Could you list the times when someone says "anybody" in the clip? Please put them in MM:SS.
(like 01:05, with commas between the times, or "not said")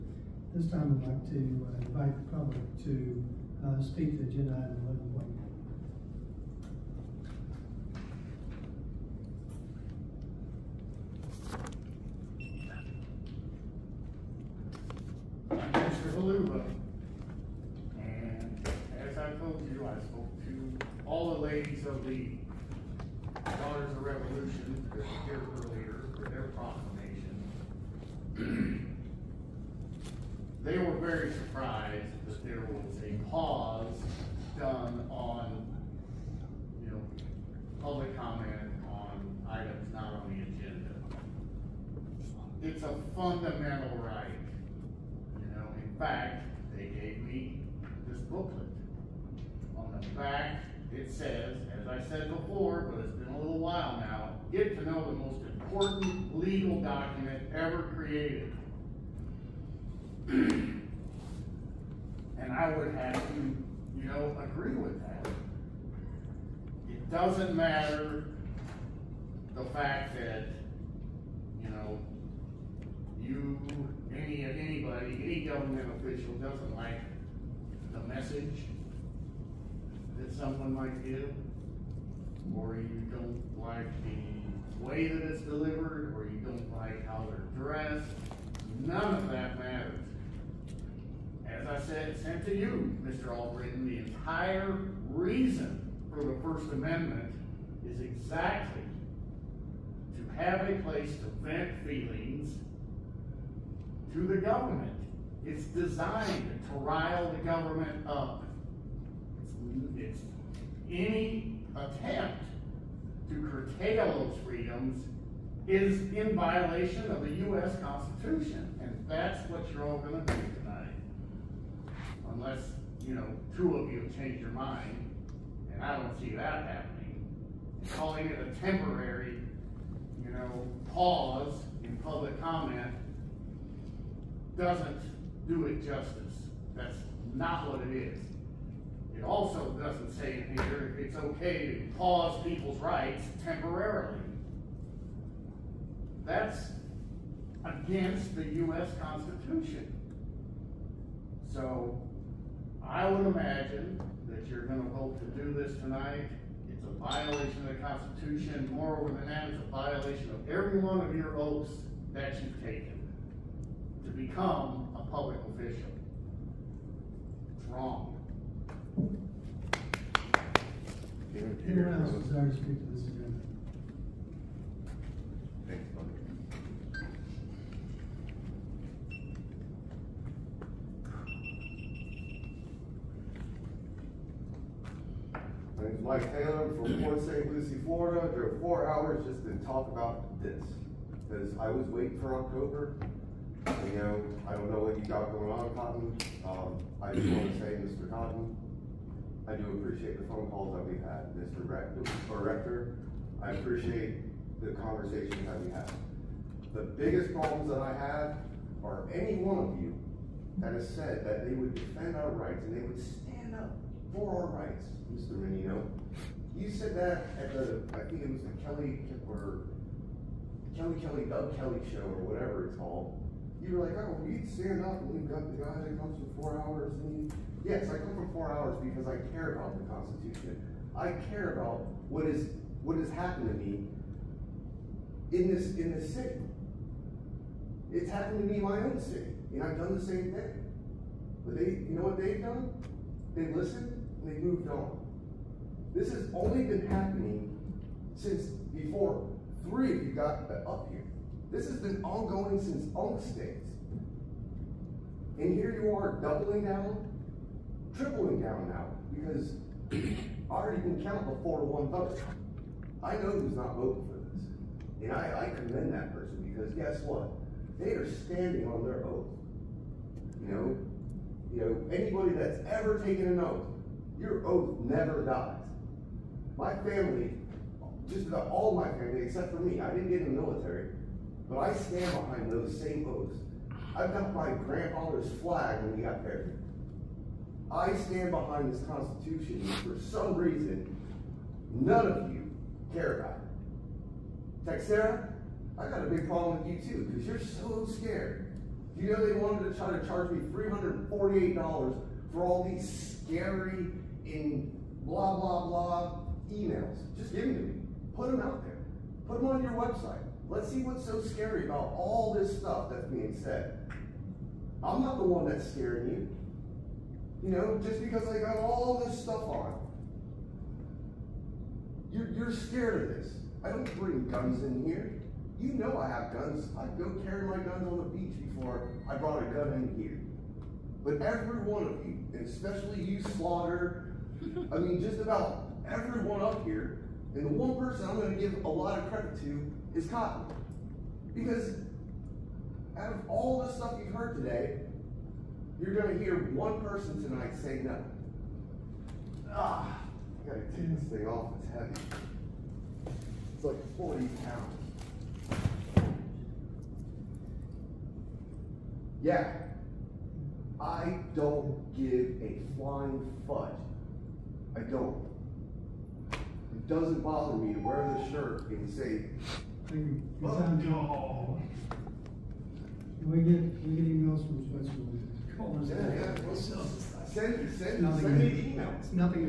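01:14, 04:31.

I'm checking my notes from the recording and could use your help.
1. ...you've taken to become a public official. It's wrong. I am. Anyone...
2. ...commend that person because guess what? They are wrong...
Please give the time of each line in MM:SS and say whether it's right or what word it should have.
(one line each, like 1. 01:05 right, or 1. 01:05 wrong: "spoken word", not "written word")
1. 02:42 right
2. 04:25 wrong: "standing", not "wrong".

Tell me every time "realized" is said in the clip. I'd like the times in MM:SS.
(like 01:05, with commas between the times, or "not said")
not said.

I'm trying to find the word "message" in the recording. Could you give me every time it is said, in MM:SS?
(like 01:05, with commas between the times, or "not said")
01:18.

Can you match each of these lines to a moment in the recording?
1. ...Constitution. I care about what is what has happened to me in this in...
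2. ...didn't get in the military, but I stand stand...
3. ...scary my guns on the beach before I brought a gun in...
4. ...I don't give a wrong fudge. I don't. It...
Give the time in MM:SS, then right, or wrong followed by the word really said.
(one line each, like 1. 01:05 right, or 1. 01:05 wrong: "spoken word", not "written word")
1. 03:49 right
2. 04:39 wrong: "behind", not "stand"
3. 05:27 wrong: "carry", not "scary"
4. 06:00 wrong: "flying", not "wrong".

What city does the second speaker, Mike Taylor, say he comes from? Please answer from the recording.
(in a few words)
Port St. Lucie.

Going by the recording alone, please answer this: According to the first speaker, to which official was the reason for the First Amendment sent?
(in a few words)
Mr. Allbritton.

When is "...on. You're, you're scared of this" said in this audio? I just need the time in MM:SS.
05:19.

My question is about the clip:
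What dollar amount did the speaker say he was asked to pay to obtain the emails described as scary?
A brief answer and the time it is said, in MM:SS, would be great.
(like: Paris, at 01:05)
$348, at 05:00.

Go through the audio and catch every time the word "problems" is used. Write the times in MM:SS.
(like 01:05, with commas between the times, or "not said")
03:27, 04:56.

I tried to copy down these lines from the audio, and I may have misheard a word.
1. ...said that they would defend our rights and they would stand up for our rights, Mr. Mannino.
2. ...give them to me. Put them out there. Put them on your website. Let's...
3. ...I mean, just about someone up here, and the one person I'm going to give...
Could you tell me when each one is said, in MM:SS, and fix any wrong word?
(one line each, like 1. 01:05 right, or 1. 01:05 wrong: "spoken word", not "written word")
1. 03:30 right
2. 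05:07 right
3. 05:34 wrong: "everyone", not "someone".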